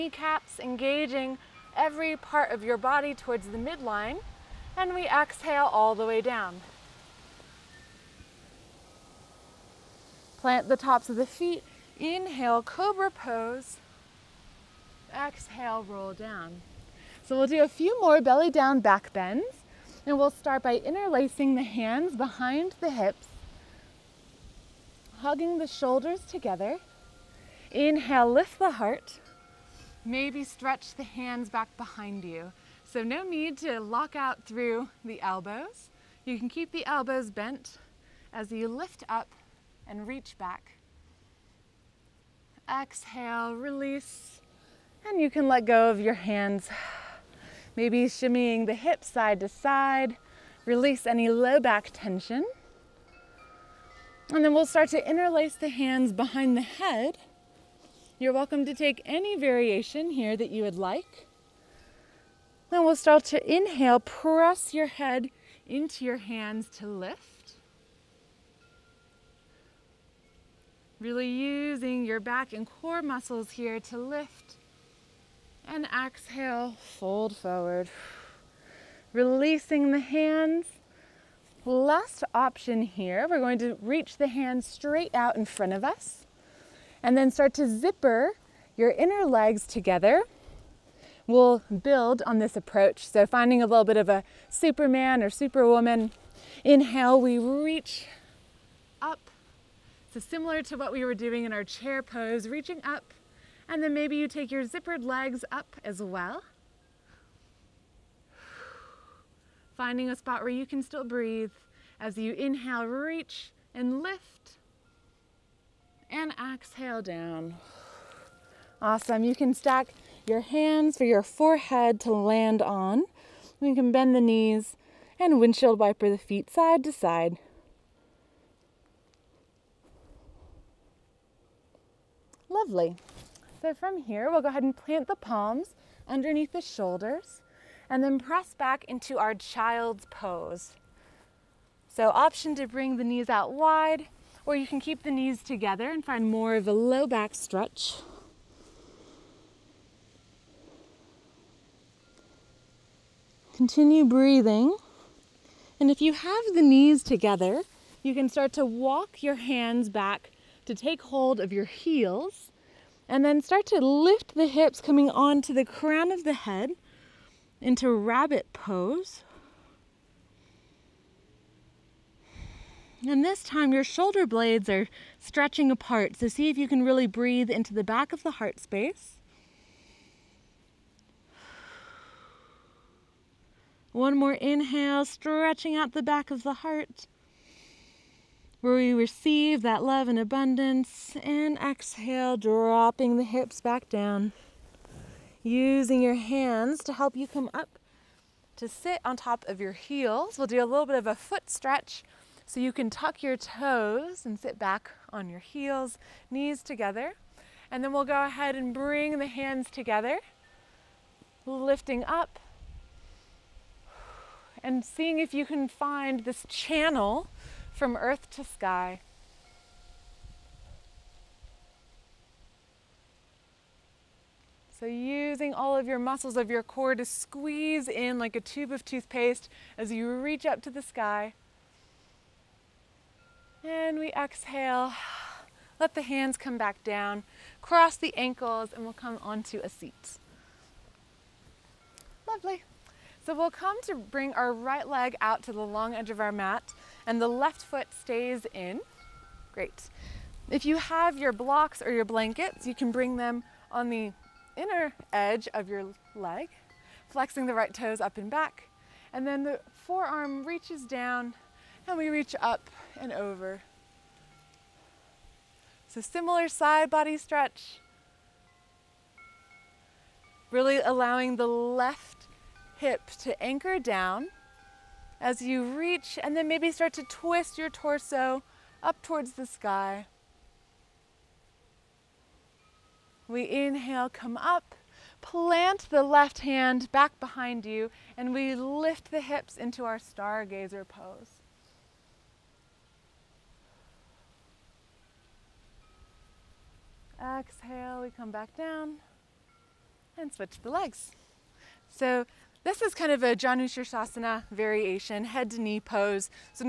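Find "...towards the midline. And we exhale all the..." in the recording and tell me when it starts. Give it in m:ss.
0:03.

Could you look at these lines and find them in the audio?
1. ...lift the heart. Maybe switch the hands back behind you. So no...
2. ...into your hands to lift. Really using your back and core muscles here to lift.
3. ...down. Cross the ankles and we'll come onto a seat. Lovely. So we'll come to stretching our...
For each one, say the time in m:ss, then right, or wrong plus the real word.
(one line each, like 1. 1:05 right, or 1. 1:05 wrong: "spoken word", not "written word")
1. 0:28 wrong: "stretch", not "switch"
2. 1:05 right
3. 3:56 wrong: "bring", not "stretching".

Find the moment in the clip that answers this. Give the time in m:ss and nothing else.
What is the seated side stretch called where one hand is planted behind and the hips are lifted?
4:49.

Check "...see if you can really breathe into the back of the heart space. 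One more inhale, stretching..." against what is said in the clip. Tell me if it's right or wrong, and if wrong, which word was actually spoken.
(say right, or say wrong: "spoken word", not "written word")
right.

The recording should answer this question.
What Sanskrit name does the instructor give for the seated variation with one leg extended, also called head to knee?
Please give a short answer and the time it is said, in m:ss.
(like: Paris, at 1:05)
Janushirshasana, at 5:03.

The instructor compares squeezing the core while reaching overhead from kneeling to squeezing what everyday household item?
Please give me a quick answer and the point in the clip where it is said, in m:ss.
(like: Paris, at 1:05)
tube of toothpaste, at 3:48.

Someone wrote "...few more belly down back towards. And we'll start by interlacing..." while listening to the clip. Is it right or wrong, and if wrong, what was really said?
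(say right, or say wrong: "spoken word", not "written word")
wrong: "bends", not "towards".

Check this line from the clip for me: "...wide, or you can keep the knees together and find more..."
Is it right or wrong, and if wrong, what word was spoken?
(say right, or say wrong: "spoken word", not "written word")
right.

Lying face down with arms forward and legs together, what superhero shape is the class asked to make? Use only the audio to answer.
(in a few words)
Superman or Superwoman.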